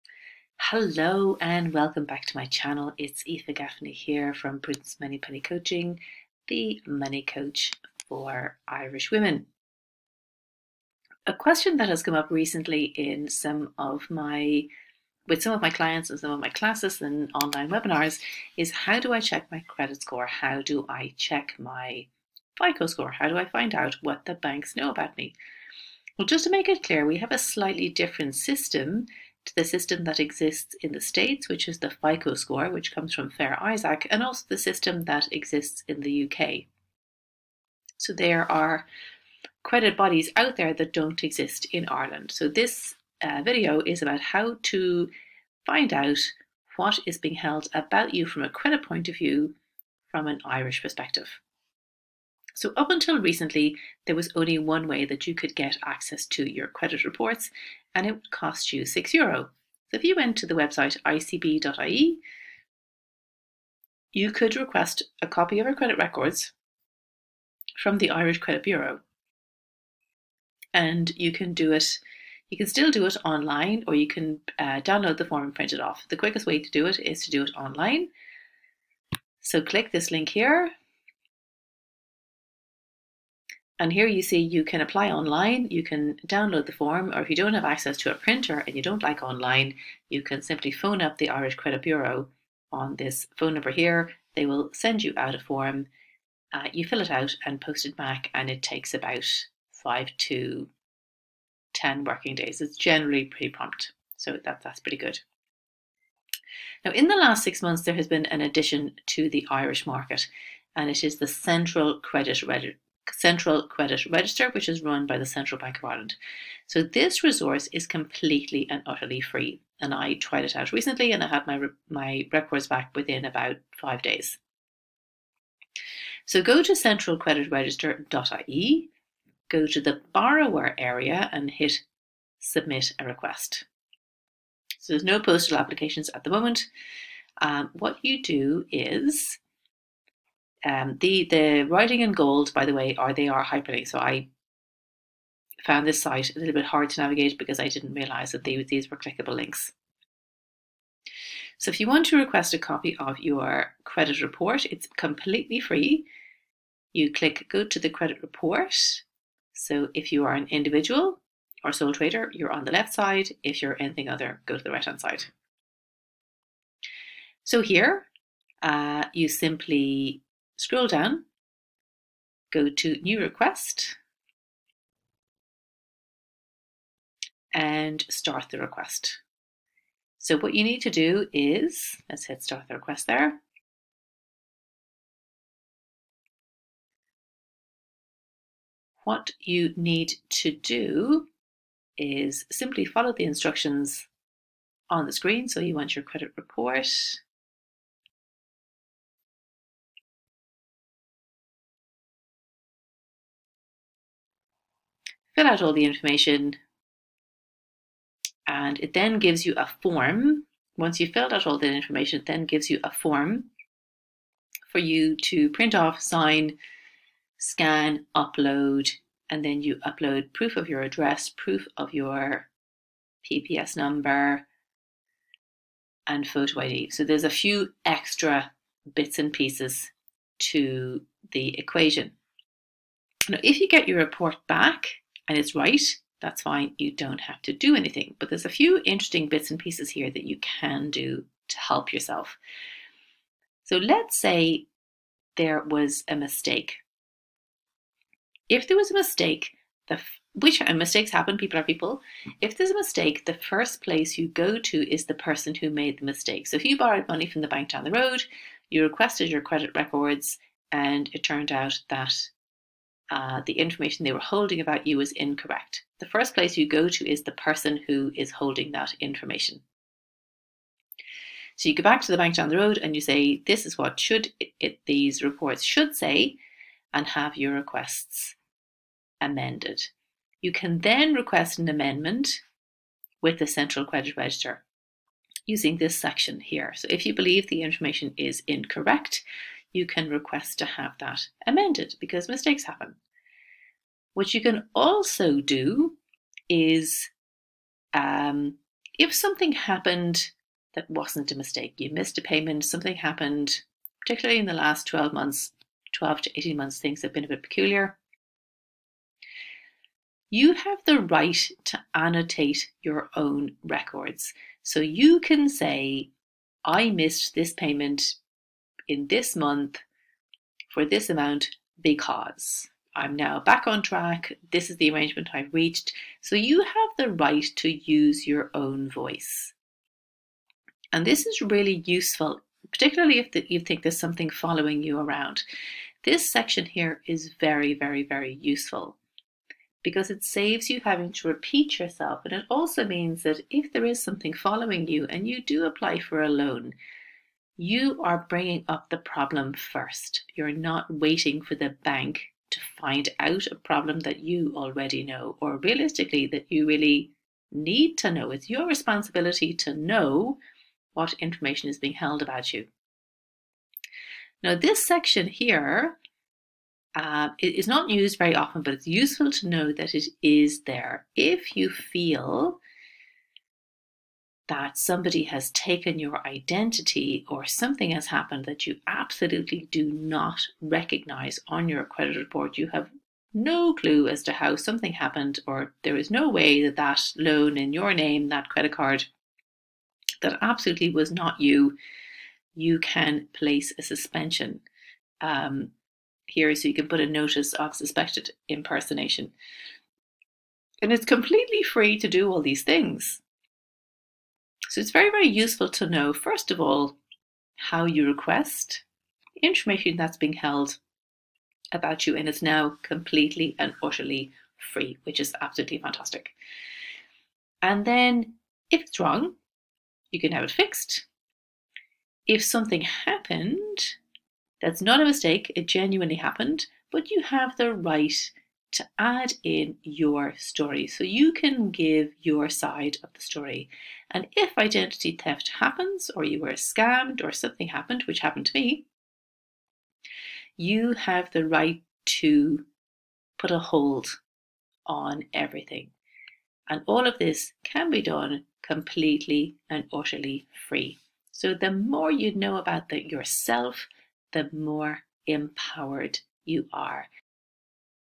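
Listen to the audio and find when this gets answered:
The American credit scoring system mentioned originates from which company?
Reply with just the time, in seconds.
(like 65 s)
33 s.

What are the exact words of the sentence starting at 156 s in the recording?
You click go to the credit report.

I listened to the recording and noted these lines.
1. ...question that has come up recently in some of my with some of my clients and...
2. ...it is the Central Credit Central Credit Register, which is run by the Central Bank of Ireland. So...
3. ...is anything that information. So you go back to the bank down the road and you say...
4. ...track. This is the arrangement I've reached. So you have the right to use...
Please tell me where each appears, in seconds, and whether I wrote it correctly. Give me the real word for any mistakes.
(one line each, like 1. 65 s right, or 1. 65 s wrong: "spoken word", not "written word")
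1. 11 s right
2. 110 s right
3. 268 s wrong: "holding", not "anything"
4. 323 s right.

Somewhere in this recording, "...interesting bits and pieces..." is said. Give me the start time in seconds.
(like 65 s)
238 s.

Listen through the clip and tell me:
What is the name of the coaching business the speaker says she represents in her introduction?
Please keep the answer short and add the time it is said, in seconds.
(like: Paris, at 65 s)
Prudence Moneypenny Coaching, at 4 s.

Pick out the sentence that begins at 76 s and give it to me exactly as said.
The quickest way to do it is to do it online.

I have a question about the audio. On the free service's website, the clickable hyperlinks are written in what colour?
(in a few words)
gold.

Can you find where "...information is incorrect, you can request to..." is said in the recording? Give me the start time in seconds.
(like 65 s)
287 s.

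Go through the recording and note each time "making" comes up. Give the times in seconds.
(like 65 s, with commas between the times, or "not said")
not said.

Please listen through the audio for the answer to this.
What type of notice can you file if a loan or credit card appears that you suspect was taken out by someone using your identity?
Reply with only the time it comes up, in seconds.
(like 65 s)
397 s.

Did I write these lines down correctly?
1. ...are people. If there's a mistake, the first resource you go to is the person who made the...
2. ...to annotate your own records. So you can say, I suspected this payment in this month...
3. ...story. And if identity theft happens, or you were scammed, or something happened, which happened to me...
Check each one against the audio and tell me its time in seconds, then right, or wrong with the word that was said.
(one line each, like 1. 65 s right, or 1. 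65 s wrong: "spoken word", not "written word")
1. 251 s wrong: "place", not "resource"
2. 311 s wrong: "missed", not "suspected"
3. 433 s right.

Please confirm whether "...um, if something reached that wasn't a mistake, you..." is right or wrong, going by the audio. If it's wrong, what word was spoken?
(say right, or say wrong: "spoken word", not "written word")
wrong: "happened", not "reached".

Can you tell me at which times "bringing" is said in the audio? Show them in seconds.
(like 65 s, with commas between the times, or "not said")
348 s.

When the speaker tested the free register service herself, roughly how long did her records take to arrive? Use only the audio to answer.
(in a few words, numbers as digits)
5 days.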